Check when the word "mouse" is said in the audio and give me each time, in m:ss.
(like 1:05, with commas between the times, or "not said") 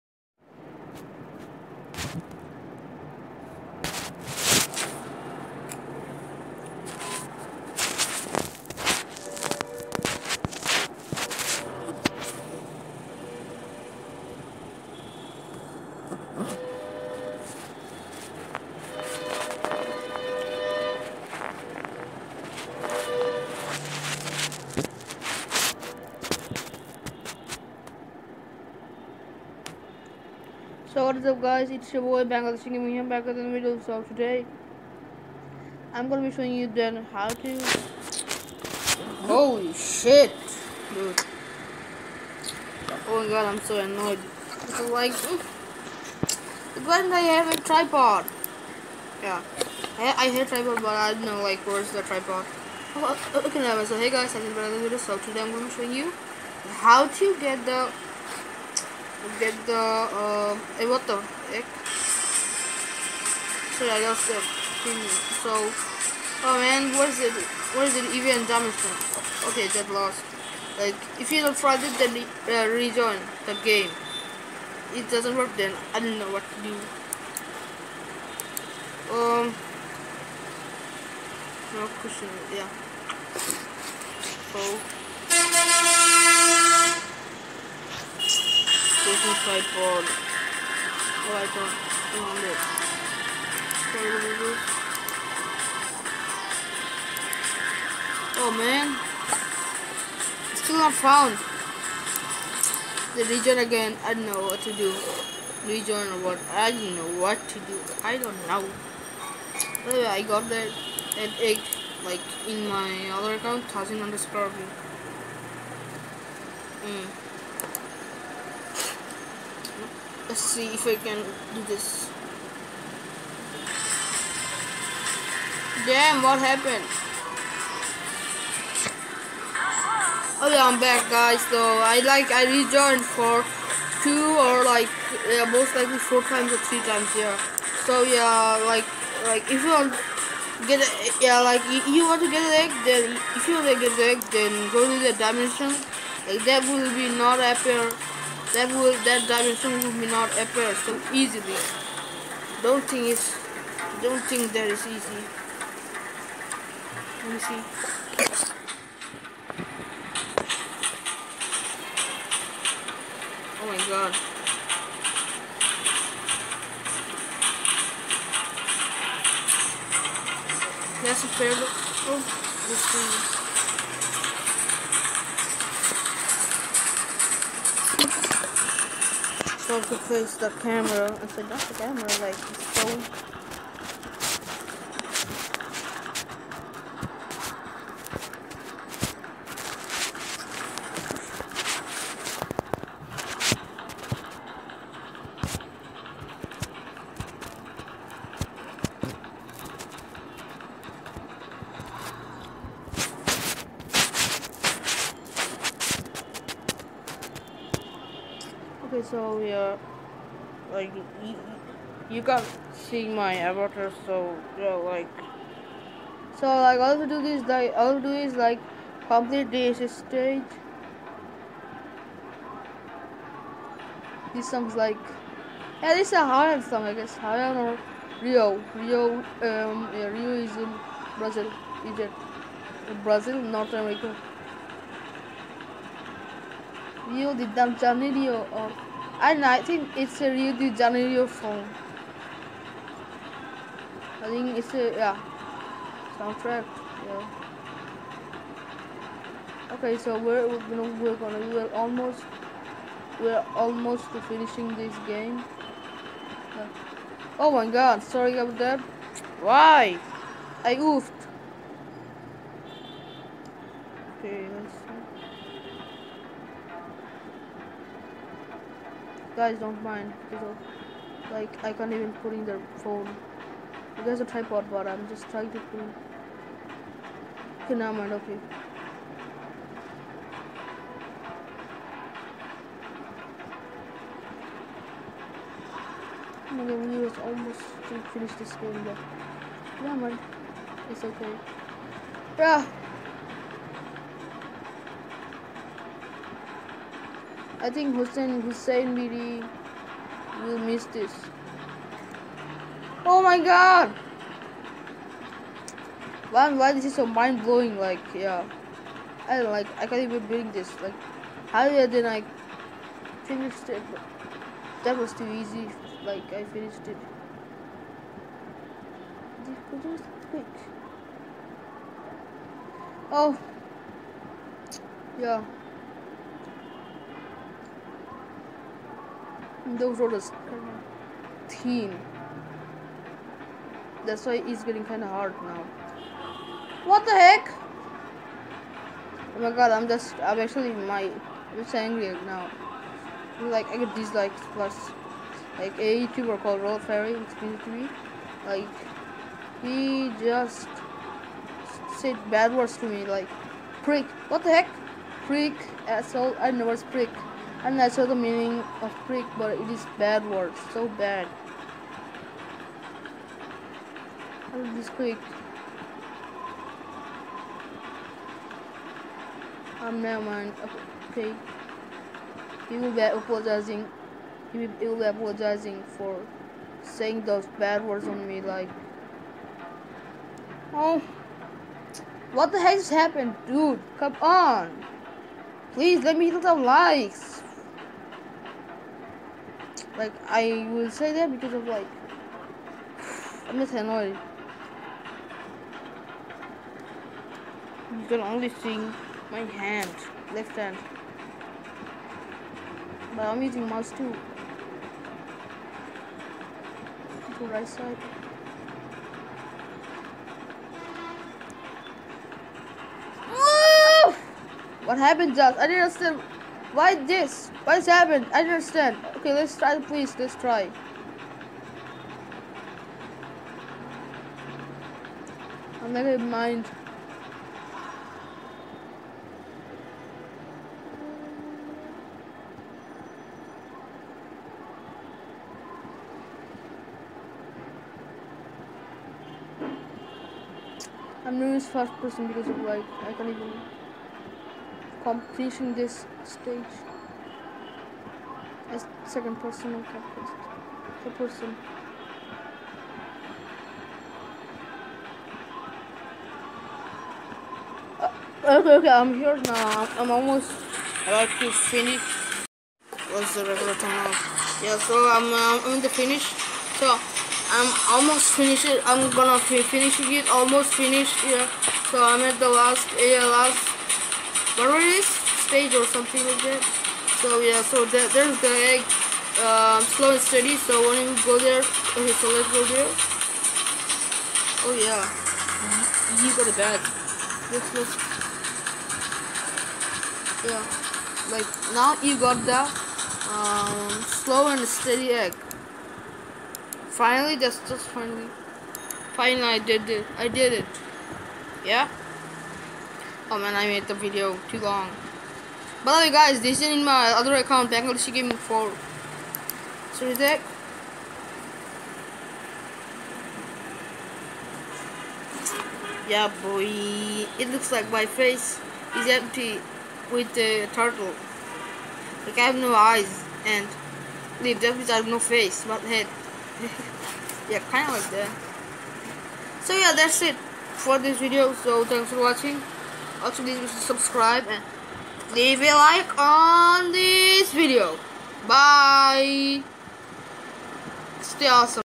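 6:43.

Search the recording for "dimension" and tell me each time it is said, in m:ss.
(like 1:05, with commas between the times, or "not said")
2:25, 2:29.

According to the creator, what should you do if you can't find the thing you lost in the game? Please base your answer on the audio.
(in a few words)
rejoin the game.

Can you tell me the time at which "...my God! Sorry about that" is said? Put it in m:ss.
4:17.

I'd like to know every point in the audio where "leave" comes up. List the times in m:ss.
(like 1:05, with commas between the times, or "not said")
8:44, 8:55.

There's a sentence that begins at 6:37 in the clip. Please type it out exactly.
You can only see my hand, left hand.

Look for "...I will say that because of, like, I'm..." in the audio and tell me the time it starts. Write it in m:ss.
6:30.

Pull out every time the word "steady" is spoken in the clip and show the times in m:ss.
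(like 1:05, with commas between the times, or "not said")
8:00, 8:14.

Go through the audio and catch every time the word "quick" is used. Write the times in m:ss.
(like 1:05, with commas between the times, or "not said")
5:20, 6:04.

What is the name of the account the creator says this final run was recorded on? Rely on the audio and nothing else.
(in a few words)
Bangladeshi Gaming 4.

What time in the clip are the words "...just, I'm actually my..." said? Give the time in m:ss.
5:39.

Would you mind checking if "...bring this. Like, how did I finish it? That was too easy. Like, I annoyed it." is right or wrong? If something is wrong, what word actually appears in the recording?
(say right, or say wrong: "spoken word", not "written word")
wrong: "finished", not "annoyed".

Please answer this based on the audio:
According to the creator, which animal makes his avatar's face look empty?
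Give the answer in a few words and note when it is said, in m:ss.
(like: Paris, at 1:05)
turtle, at 8:40.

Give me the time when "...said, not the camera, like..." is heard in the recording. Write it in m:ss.
3:01.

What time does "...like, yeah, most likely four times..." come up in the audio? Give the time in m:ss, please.
2:14.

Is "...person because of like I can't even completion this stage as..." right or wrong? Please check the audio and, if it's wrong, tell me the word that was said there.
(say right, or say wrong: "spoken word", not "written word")
right.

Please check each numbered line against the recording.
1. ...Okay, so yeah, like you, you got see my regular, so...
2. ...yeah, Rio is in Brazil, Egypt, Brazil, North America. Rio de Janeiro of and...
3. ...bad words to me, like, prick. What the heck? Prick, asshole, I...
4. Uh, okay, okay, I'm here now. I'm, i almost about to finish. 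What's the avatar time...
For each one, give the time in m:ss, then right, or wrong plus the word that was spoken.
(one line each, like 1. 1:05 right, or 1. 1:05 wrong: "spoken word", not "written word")
1. 3:28 wrong: "avatar", not "regular"
2. 3:49 right
3. 5:52 right
4. 7:37 wrong: "regular", not "avatar".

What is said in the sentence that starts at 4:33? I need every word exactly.
You guys are tripod, but I'm just trying to put Can Okay, now mind, okay.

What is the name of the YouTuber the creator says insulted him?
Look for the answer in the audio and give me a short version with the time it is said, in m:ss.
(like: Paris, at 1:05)
Roll Fairy, at 5:46.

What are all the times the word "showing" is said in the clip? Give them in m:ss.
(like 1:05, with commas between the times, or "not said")
0:36, 0:55.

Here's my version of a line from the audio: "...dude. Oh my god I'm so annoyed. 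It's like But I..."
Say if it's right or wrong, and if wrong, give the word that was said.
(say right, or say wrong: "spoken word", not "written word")
right.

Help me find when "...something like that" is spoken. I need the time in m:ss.
7:55.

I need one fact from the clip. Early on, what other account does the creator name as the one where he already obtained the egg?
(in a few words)
thousand underscore.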